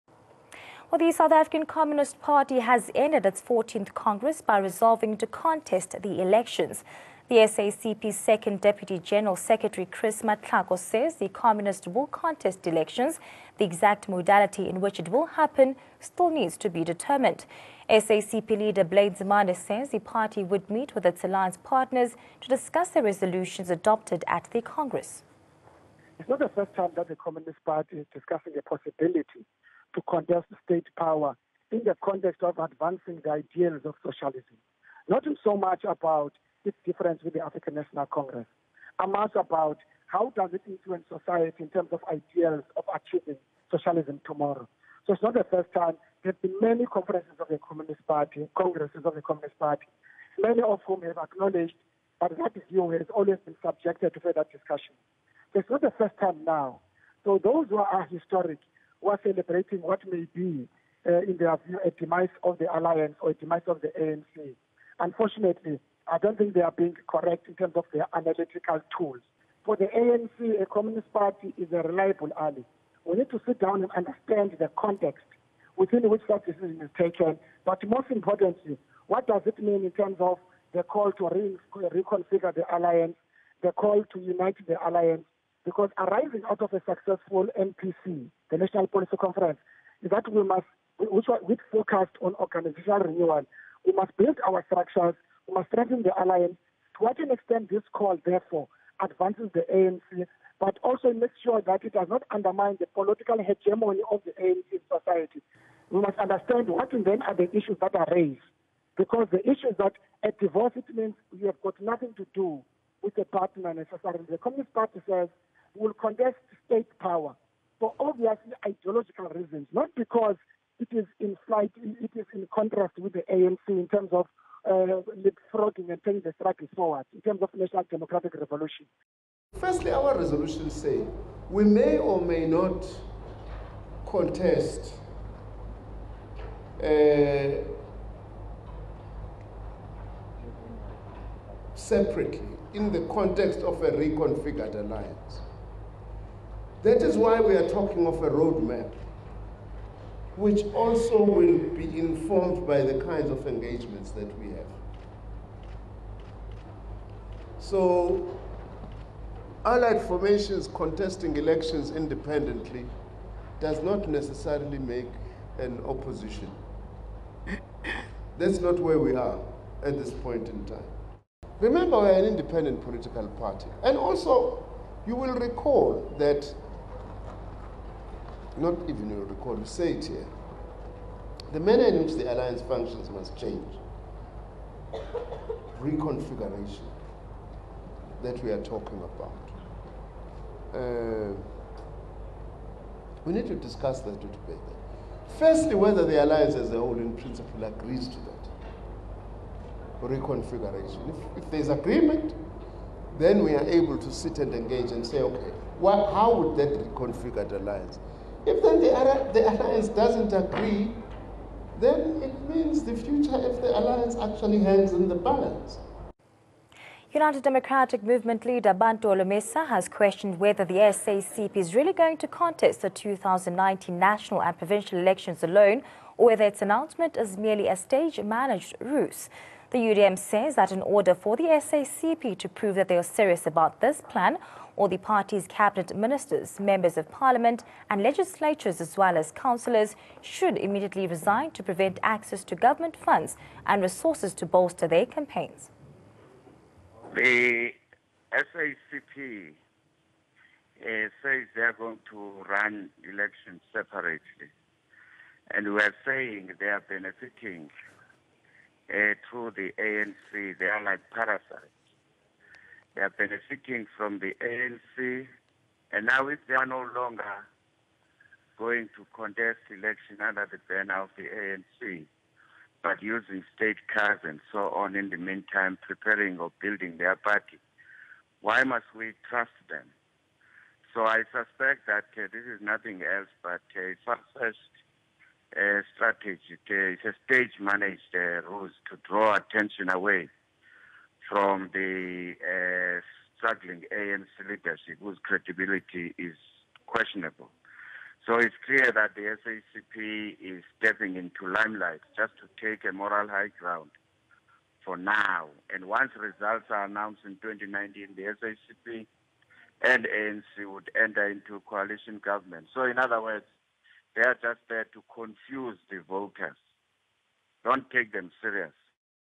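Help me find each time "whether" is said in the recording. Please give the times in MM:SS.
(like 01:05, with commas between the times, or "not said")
03:15, 03:40, 03:46.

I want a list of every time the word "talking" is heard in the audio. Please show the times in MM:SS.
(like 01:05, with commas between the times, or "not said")
02:27, 03:08.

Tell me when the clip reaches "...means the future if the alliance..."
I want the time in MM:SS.
03:32.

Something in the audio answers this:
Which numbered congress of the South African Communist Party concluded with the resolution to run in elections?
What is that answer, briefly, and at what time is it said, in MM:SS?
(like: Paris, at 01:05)
14th, at 00:03.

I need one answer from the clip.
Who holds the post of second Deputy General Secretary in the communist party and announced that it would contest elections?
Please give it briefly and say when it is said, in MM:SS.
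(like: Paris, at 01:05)
Chris Matlhako, at 00:09.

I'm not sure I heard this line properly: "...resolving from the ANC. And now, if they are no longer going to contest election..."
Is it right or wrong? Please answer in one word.
wrong.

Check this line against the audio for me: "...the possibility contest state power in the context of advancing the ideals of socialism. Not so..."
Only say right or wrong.
right.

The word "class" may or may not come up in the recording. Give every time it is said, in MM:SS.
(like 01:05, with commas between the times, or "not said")
not said.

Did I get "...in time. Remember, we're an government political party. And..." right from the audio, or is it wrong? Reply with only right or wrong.
wrong.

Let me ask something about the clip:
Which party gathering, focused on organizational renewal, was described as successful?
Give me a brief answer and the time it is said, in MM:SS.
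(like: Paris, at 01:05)
National Policy Conference, at 01:28.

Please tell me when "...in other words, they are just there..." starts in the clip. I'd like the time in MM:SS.
05:12.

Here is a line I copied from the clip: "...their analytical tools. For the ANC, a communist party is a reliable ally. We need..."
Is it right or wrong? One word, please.
right.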